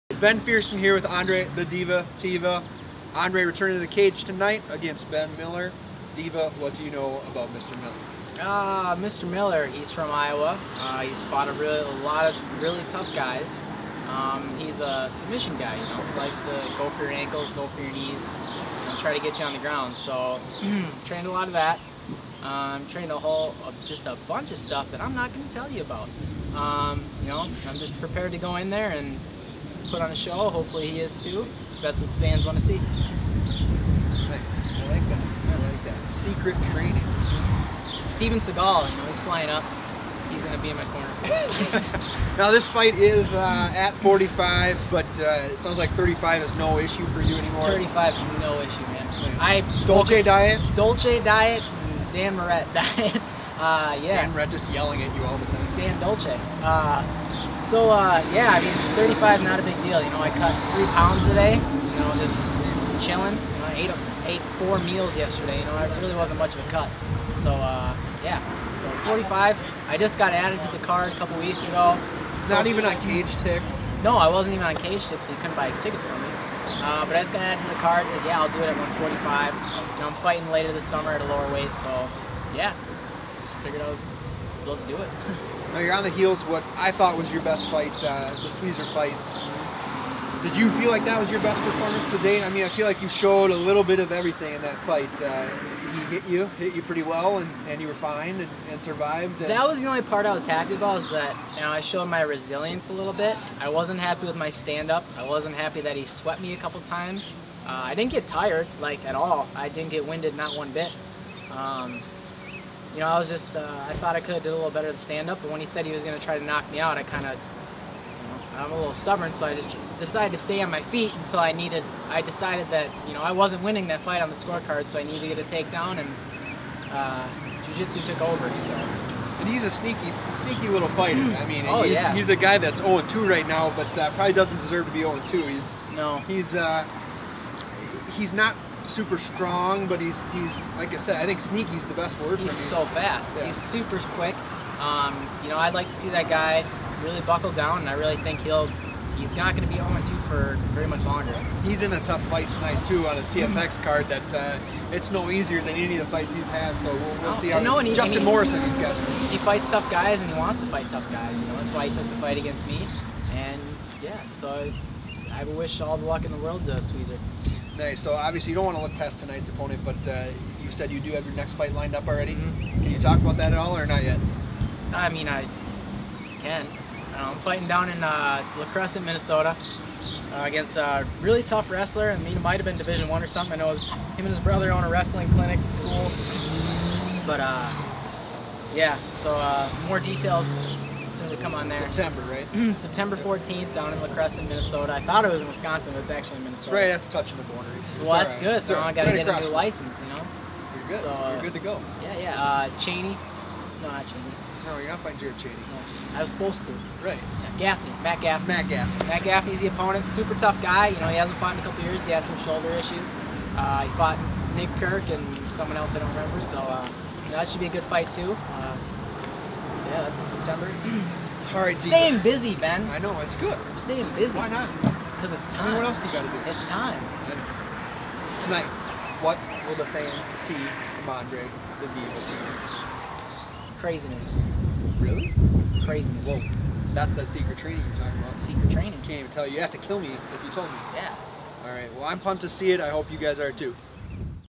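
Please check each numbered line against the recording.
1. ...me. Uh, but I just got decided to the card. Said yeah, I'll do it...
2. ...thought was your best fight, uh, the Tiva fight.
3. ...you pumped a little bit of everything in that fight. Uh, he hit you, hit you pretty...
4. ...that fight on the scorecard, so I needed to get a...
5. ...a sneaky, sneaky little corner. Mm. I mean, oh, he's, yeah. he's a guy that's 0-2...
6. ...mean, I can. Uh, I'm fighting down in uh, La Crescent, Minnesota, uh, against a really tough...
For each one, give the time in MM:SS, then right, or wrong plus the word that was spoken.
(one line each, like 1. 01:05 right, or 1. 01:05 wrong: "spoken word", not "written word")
1. 01:16 wrong: "added", not "decided"
2. 01:26 wrong: "Sweezer", not "Tiva"
3. 01:32 wrong: "showed", not "pumped"
4. 02:03 right
5. 02:09 wrong: "fighter", not "corner"
6. 02:55 right.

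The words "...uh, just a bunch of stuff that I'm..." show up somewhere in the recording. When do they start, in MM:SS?
00:23.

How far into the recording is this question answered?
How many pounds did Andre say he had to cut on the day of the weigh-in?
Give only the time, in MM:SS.
01:00.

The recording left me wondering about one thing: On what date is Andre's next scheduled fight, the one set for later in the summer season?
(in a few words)
September 14th.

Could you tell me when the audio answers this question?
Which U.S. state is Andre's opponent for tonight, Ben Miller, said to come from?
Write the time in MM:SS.
00:10.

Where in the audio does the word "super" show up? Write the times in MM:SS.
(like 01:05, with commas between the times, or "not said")
02:18, 02:23, 03:30.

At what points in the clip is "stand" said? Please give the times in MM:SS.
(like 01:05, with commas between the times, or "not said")
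01:44, 01:54.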